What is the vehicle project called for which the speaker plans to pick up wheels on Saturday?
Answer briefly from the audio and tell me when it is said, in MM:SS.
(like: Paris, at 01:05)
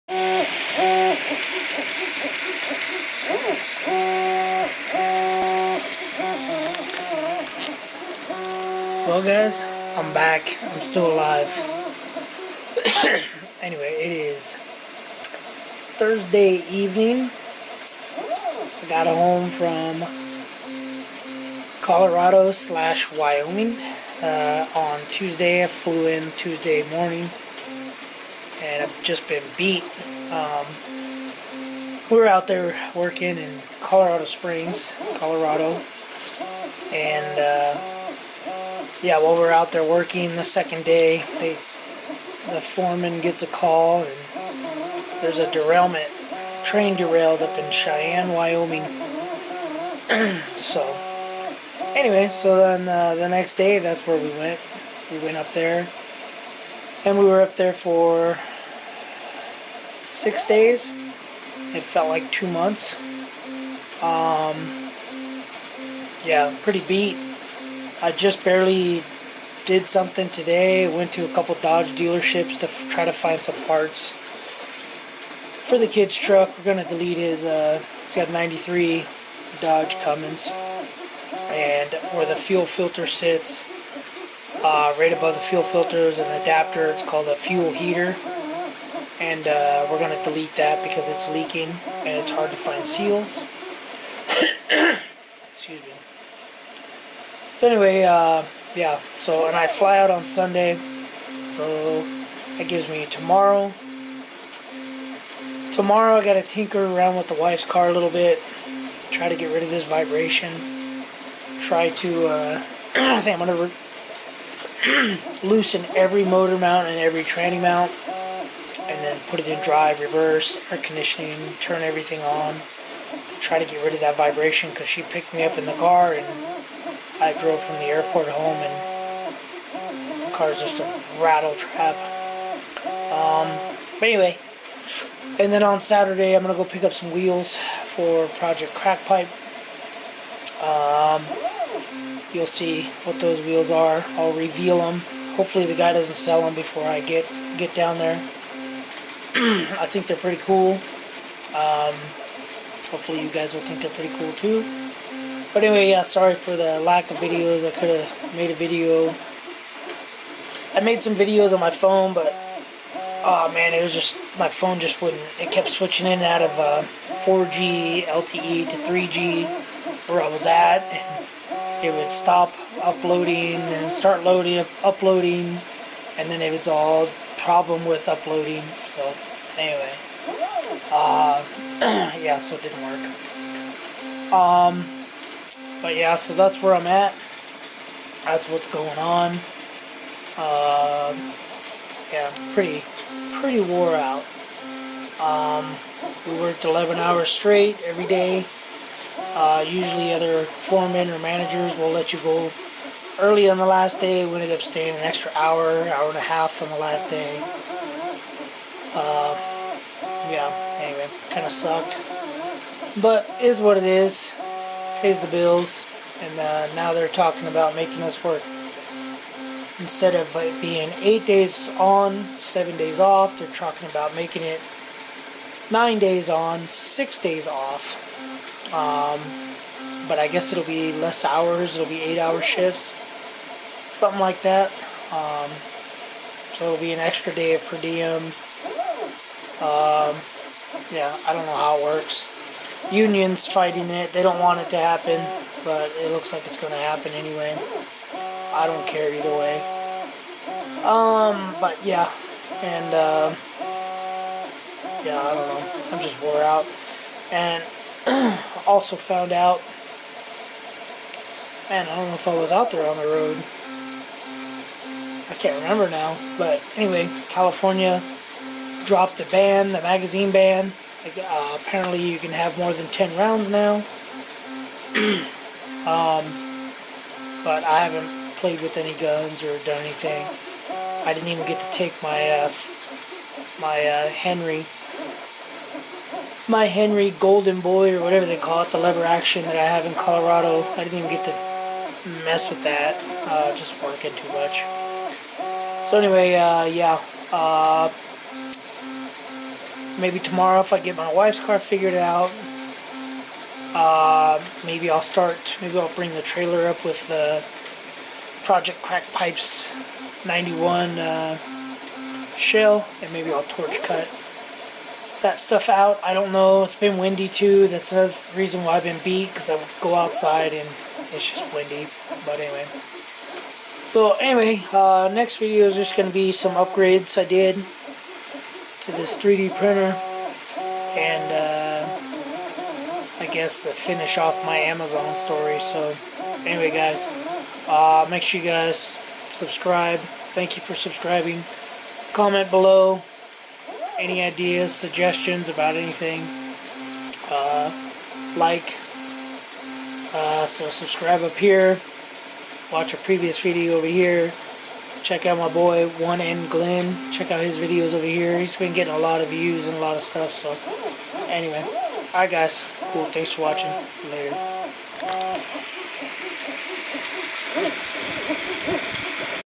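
Project Crackpipe, at 02:18.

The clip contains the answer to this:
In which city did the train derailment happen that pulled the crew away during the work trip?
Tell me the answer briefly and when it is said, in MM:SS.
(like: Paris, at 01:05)
Cheyenne, at 00:47.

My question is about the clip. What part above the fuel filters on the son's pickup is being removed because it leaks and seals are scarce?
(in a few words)
fuel heater.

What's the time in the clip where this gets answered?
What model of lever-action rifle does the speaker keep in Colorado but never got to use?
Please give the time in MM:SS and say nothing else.
04:46.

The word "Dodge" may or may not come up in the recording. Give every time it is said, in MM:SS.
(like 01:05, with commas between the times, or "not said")
01:11, 01:19.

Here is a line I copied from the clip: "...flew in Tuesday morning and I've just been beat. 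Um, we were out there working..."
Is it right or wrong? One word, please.
right.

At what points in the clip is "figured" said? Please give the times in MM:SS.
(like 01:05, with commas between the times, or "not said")
05:01.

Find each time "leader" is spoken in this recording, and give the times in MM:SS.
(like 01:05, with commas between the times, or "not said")
not said.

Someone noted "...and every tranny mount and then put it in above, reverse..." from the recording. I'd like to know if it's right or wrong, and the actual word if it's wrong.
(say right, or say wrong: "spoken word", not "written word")
wrong: "drive", not "above".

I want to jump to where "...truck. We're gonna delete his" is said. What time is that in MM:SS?
01:16.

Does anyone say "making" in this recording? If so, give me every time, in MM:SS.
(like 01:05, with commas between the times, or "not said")
03:37, 03:44.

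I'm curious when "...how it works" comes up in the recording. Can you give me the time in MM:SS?
04:01.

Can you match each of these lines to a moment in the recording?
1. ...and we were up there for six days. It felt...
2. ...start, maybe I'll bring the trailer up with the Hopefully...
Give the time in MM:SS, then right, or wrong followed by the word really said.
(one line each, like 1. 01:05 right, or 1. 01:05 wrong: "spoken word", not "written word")
1. 00:57 right
2. 05:05 wrong: "Project", not "Hopefully".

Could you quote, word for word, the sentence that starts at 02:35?
But anyway, yeah, sorry for the lack of videos.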